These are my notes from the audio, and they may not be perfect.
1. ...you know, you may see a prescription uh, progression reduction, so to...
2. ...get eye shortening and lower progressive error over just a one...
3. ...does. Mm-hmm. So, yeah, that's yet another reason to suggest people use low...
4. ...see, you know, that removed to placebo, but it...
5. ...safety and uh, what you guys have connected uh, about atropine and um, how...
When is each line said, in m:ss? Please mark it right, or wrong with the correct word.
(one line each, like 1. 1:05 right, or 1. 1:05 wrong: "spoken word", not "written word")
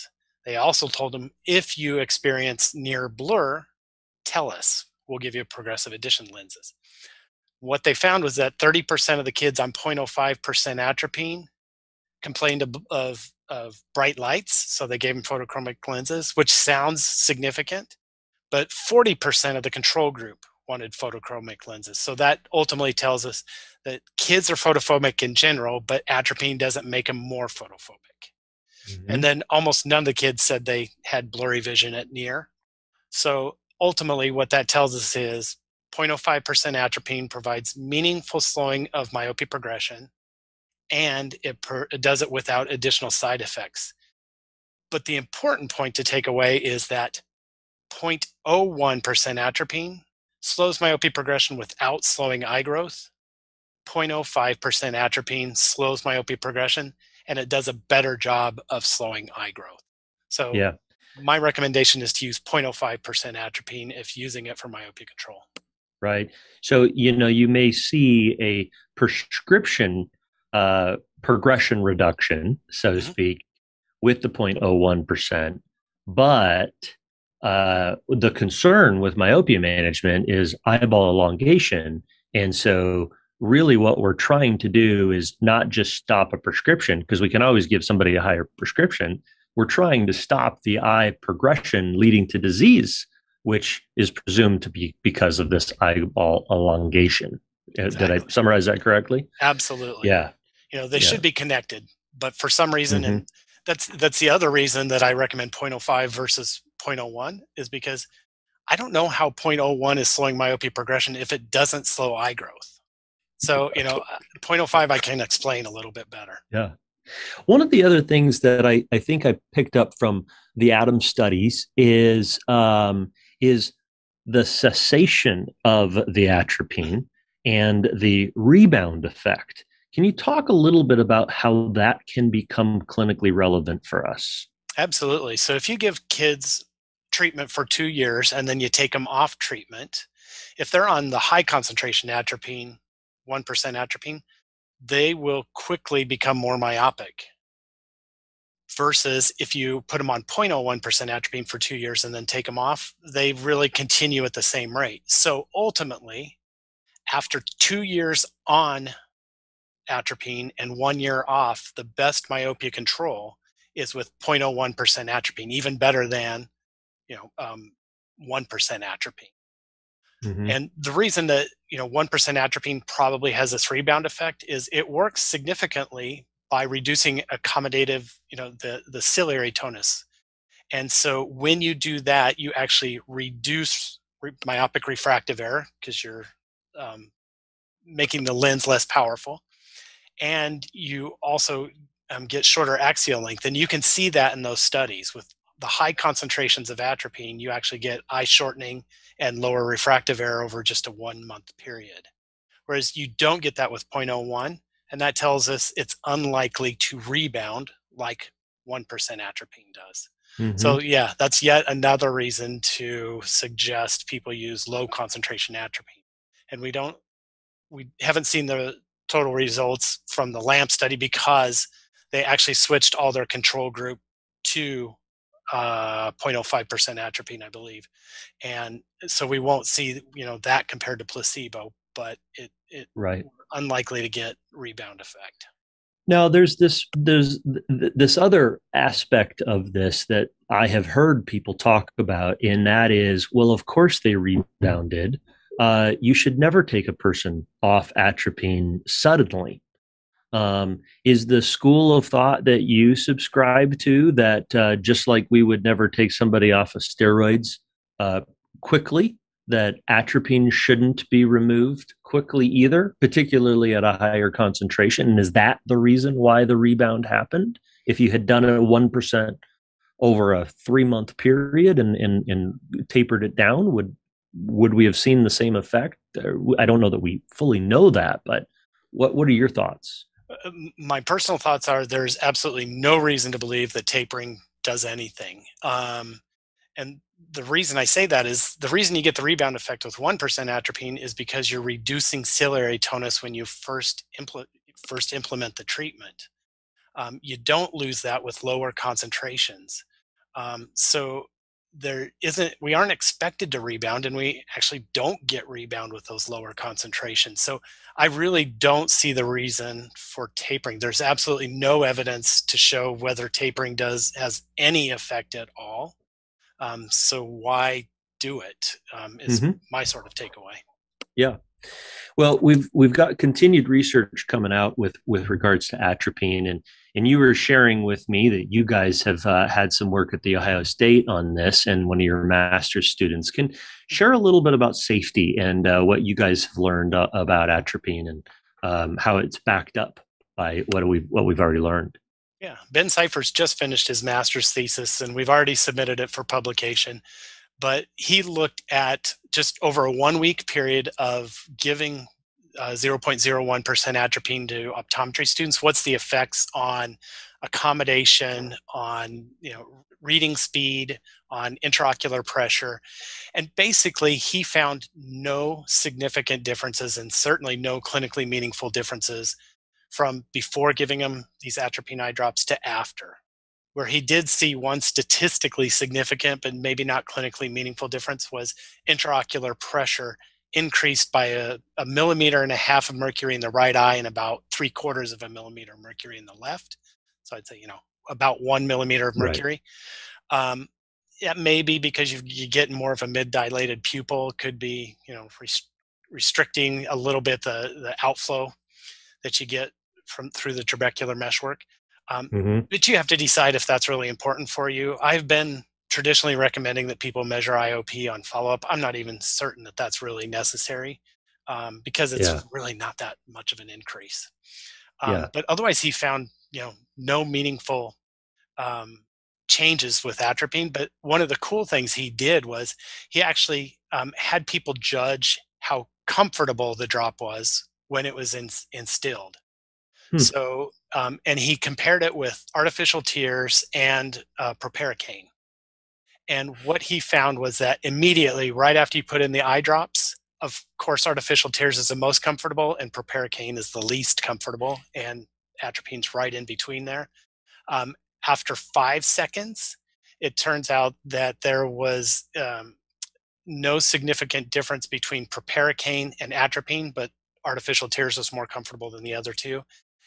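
1. 1:06 right
2. 3:17 wrong: "refractive", not "progressive"
3. 3:29 right
4. 3:49 wrong: "compared", not "removed"
5. 5:34 wrong: "learned", not "connected".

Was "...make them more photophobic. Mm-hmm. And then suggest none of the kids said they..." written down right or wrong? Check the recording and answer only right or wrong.
wrong.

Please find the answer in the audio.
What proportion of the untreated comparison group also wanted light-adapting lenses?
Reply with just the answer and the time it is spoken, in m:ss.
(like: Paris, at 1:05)
40%, at 0:18.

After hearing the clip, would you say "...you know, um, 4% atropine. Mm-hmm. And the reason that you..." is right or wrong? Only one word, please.
wrong.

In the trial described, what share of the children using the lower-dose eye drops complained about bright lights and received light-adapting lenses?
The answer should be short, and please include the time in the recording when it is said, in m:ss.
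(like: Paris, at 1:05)
30%, at 0:08.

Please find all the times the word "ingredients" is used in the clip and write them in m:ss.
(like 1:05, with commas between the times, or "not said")
not said.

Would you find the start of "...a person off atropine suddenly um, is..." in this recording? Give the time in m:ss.
4:06.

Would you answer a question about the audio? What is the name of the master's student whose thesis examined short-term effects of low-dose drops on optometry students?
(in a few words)
Ben Cypher.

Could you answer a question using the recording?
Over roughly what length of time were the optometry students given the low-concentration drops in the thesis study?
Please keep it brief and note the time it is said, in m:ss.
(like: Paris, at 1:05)
one week, at 5:49.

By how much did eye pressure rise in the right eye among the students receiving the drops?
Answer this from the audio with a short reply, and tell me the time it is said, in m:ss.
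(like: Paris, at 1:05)
1.5 mmHg, at 6:21.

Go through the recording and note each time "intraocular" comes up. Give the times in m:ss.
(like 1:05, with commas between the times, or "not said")
6:01, 6:18.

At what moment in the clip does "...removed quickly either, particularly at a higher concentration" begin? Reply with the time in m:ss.
4:21.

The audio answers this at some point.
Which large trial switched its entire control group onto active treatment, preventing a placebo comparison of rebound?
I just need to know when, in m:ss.
3:40.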